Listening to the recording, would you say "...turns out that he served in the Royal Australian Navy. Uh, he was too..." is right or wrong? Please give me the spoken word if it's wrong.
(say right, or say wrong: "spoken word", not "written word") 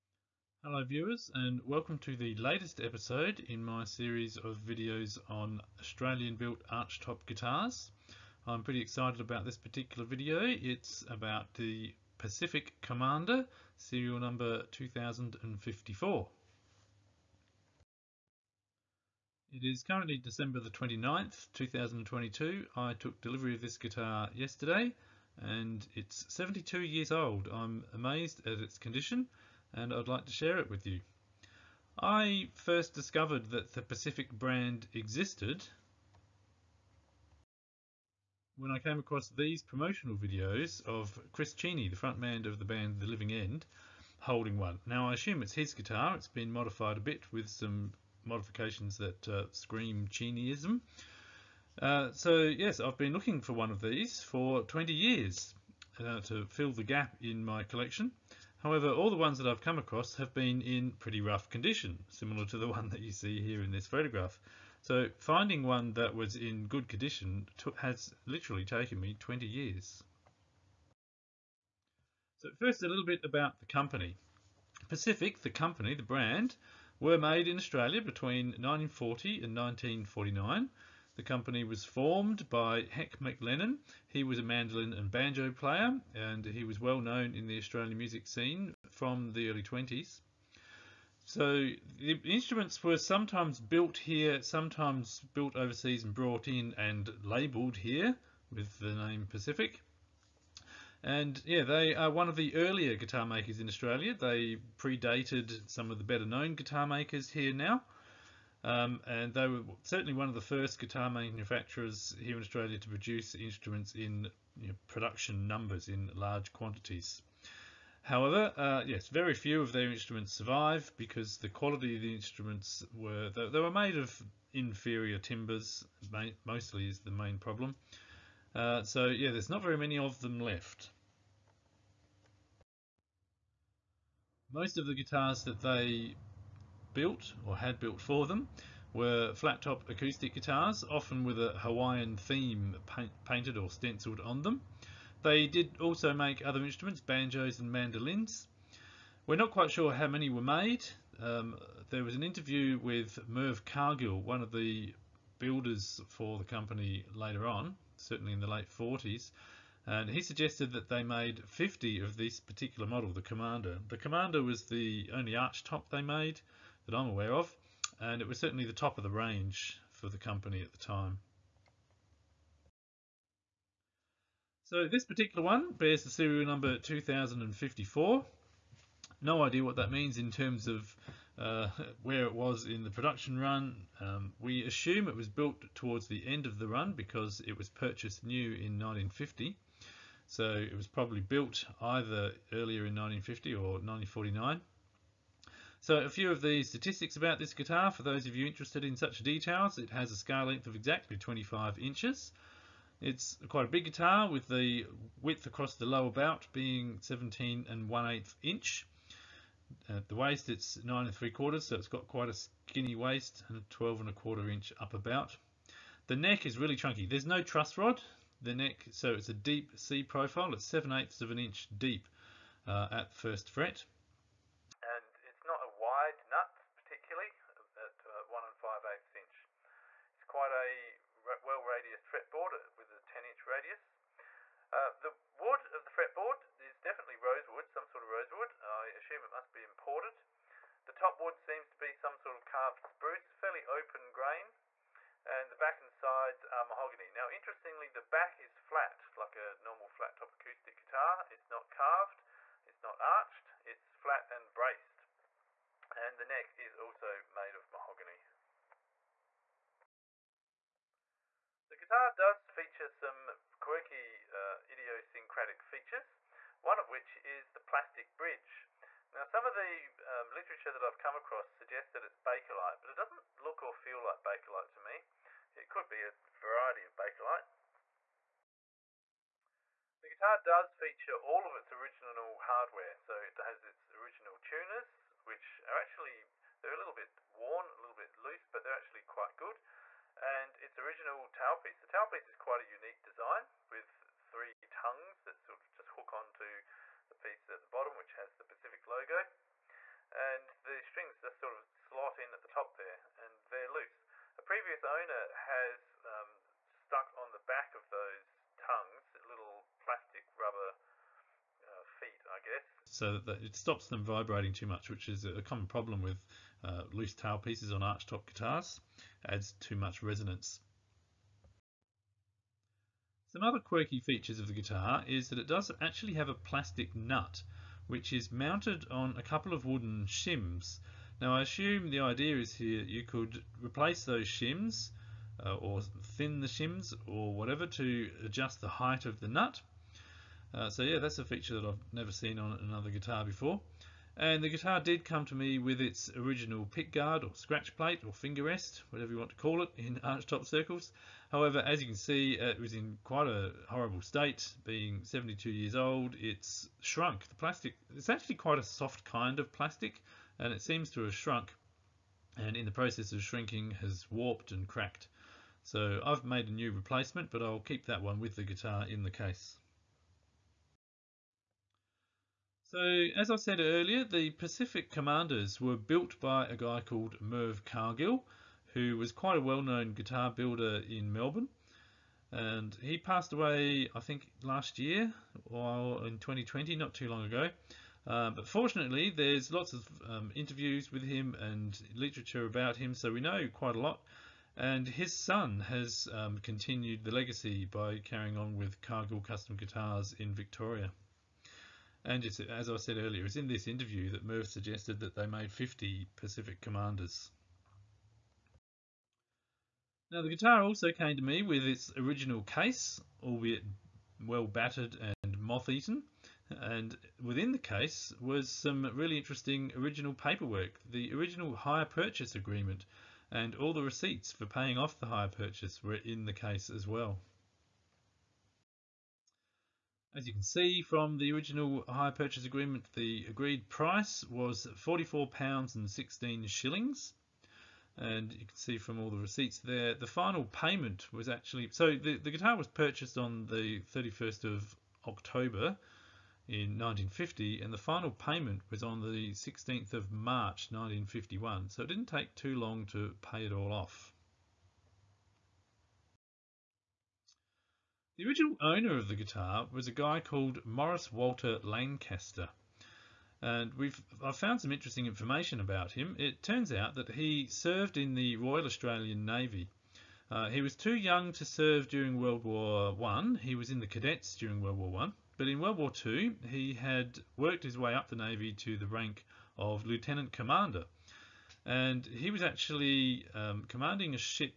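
right.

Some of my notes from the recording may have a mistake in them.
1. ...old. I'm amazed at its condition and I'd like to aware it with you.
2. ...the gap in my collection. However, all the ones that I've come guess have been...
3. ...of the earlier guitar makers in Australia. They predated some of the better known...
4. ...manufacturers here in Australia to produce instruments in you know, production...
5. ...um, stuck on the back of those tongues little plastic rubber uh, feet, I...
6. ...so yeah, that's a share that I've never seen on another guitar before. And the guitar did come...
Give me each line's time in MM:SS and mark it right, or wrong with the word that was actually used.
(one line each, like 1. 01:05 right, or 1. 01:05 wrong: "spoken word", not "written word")
1. 00:27 wrong: "share", not "aware"
2. 00:56 wrong: "across", not "guess"
3. 01:42 right
4. 01:51 right
5. 05:06 right
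6. 05:40 wrong: "feature", not "share".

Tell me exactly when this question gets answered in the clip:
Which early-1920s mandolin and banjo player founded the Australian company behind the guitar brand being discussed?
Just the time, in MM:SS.
01:22.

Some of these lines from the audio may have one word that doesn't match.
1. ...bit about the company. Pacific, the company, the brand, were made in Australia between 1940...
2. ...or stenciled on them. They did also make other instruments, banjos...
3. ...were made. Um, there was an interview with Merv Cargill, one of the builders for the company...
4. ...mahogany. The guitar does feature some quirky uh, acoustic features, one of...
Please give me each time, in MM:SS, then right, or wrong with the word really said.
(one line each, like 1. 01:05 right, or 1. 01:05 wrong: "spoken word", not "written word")
1. 01:13 right
2. 02:23 right
3. 02:30 right
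4. 04:17 wrong: "idiosyncratic", not "acoustic".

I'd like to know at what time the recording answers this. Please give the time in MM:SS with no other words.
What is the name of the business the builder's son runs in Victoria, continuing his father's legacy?
06:38.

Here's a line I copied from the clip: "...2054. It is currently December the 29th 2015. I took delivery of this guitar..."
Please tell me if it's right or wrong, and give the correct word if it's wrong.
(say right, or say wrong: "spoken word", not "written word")
wrong: "2022", not "2015".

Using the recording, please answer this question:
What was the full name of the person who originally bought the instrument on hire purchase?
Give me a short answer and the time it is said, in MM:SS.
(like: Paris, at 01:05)
Morris Walter Lancaster, at 07:40.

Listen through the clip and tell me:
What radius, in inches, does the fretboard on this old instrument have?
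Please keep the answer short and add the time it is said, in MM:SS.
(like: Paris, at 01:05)
10 inch, at 03:53.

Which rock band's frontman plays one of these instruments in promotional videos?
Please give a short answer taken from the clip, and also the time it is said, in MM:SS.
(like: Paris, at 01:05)
The Living End, at 00:43.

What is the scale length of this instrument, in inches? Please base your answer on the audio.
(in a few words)
25 inches.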